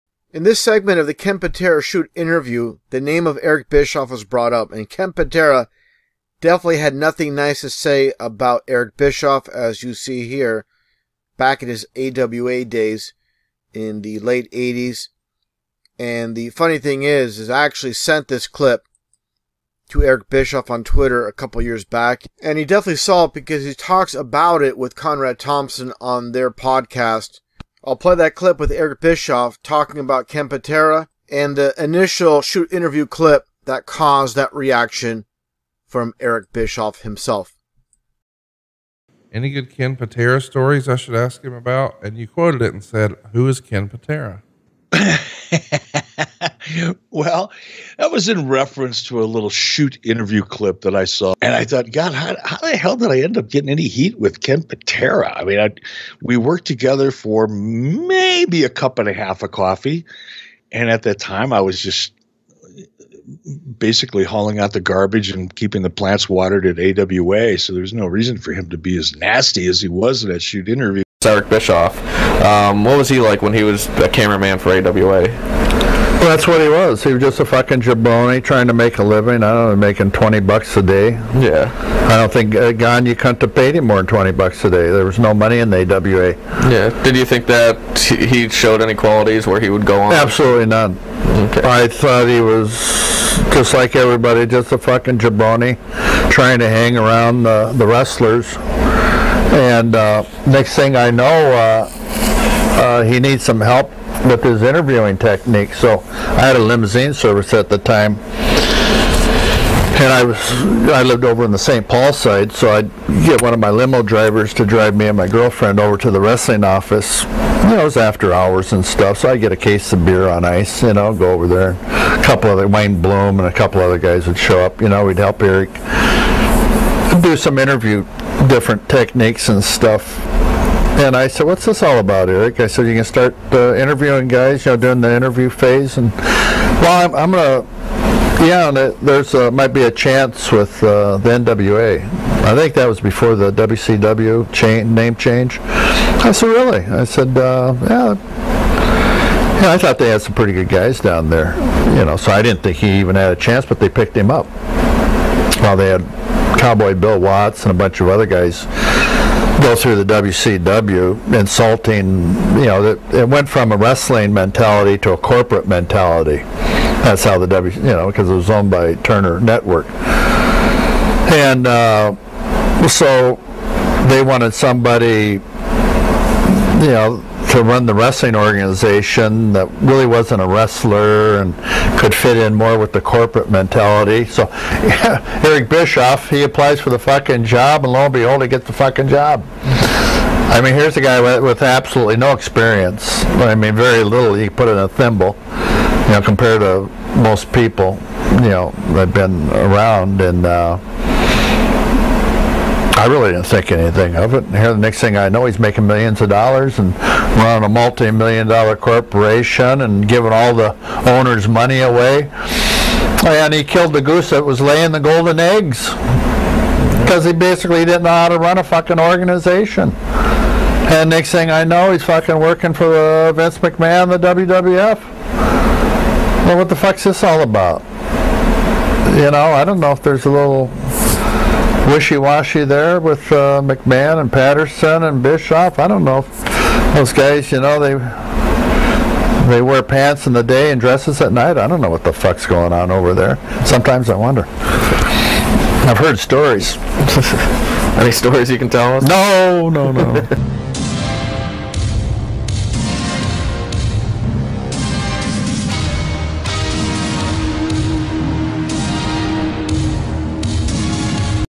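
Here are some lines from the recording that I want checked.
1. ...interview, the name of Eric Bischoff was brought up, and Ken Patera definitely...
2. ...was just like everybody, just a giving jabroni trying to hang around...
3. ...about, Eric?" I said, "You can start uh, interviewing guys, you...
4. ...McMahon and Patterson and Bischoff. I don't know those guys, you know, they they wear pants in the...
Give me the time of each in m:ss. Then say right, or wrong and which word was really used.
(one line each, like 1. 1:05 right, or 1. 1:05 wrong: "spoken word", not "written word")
1. 0:02 right
2. 1:32 wrong: "fucking", not "giving"
3. 2:11 right
4. 3:53 right.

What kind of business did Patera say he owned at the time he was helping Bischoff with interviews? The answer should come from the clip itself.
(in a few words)
Limousine service.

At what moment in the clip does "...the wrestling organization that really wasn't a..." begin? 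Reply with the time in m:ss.
2:57.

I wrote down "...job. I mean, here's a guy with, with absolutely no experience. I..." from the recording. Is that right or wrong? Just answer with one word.
right.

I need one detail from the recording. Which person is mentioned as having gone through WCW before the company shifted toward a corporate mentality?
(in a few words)
Cowboy Bill Watts.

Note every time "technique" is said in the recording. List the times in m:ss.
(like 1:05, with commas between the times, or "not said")
1:45, 2:08.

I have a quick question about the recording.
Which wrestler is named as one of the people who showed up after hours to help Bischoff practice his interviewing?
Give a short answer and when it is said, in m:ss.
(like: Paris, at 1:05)
Wayne Bloom, at 2:02.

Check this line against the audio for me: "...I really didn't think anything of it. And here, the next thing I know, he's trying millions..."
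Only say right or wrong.
wrong.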